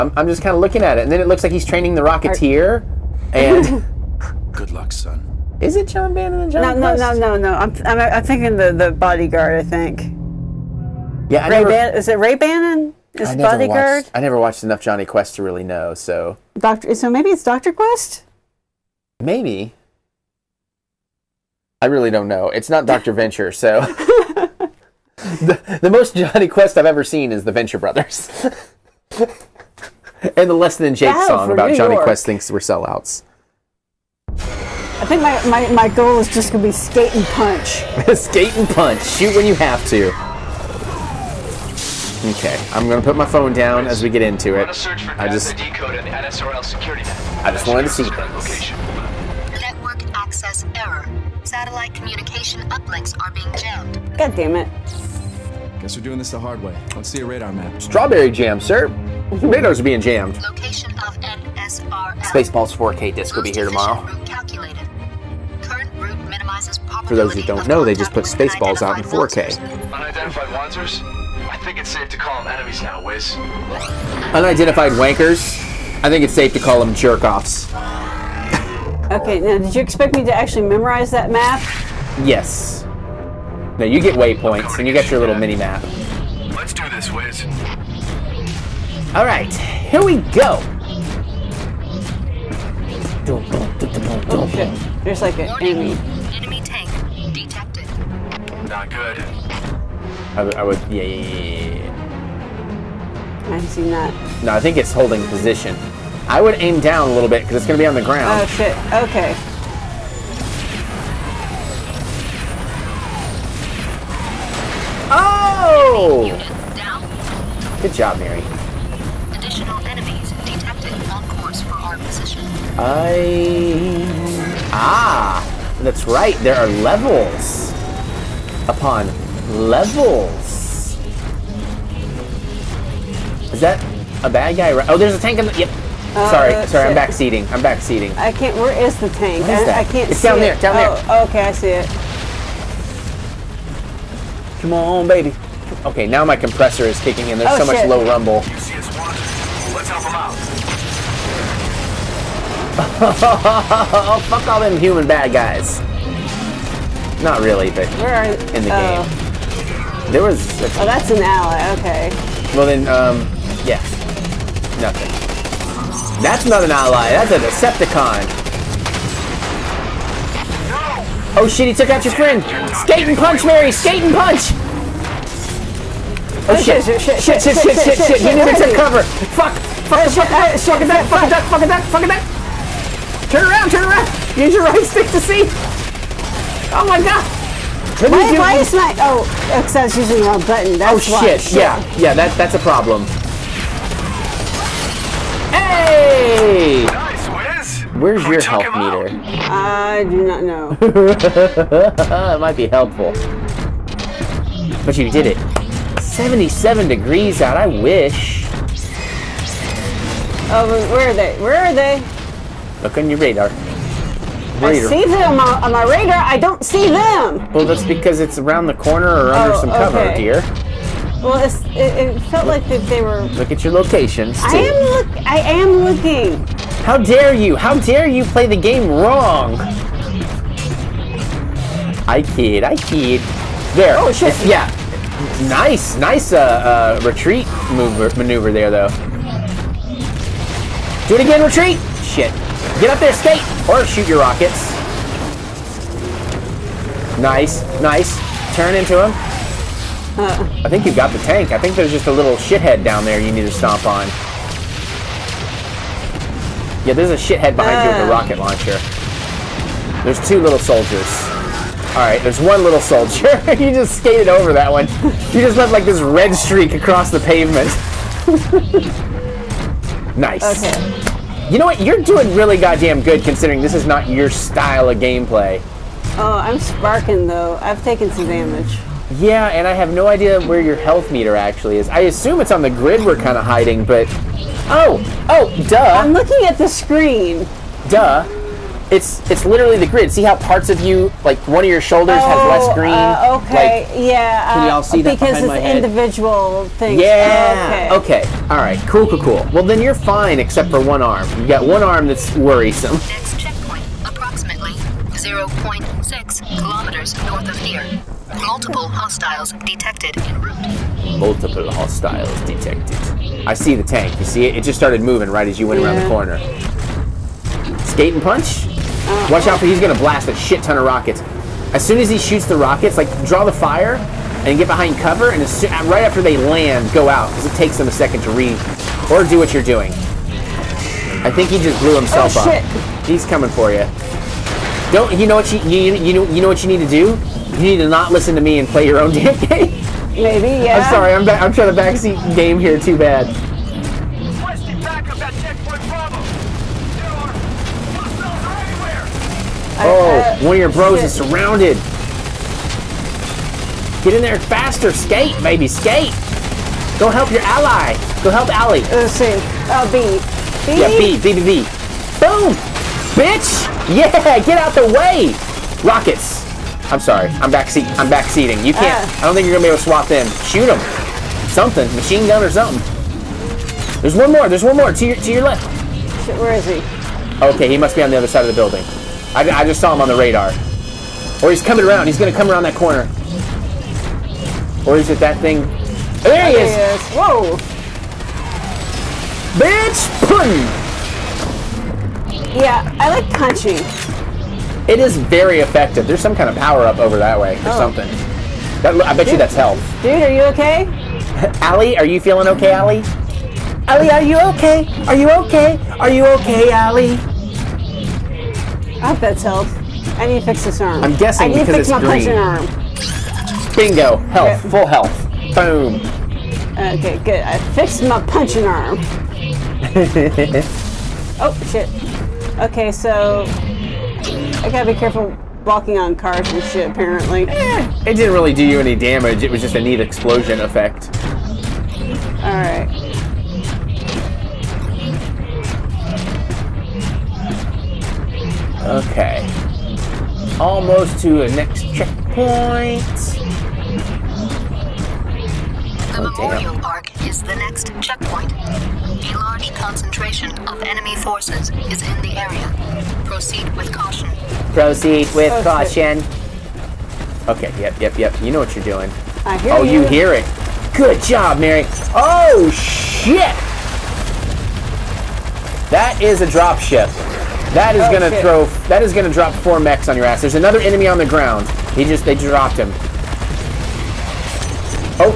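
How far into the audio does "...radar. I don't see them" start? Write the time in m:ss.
3:35.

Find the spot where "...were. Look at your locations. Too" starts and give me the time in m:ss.
3:43.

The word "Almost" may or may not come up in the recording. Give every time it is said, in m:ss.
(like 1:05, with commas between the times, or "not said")
7:20.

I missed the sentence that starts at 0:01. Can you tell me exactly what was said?
And then it looks like he's training the Rocketeer.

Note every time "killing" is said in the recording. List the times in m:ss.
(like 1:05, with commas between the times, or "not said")
not said.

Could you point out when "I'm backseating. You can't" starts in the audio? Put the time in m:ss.
6:07.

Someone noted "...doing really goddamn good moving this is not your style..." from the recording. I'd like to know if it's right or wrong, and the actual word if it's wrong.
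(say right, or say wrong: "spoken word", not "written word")
wrong: "considering", not "moving".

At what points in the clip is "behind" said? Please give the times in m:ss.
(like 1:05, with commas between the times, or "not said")
4:17, 5:24.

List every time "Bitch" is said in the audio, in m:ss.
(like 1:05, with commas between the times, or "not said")
6:03, 6:29.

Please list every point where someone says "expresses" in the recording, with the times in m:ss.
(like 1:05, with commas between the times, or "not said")
not said.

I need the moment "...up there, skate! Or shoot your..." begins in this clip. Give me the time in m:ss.
4:02.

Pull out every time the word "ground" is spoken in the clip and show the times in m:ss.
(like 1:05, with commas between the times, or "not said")
1:48, 7:51.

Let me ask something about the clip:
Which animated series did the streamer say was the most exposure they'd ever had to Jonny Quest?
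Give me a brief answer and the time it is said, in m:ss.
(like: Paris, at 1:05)
The Venture Brothers, at 0:27.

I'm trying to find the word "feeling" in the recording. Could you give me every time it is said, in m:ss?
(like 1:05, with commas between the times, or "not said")
6:42.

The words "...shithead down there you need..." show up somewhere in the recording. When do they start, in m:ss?
4:12.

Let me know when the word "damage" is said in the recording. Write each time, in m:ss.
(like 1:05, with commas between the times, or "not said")
4:38, 7:08.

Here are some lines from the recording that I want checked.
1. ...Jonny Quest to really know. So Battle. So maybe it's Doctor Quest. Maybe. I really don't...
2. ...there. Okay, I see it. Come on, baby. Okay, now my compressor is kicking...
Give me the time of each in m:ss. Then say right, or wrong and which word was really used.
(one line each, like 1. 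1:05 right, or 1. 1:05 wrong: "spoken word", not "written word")
1. 0:14 wrong: "Doctor", not "Battle"
2. 2:21 right.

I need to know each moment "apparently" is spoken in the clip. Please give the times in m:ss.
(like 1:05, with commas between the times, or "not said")
7:06.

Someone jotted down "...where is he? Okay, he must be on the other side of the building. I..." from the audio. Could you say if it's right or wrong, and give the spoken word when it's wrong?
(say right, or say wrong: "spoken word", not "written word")
right.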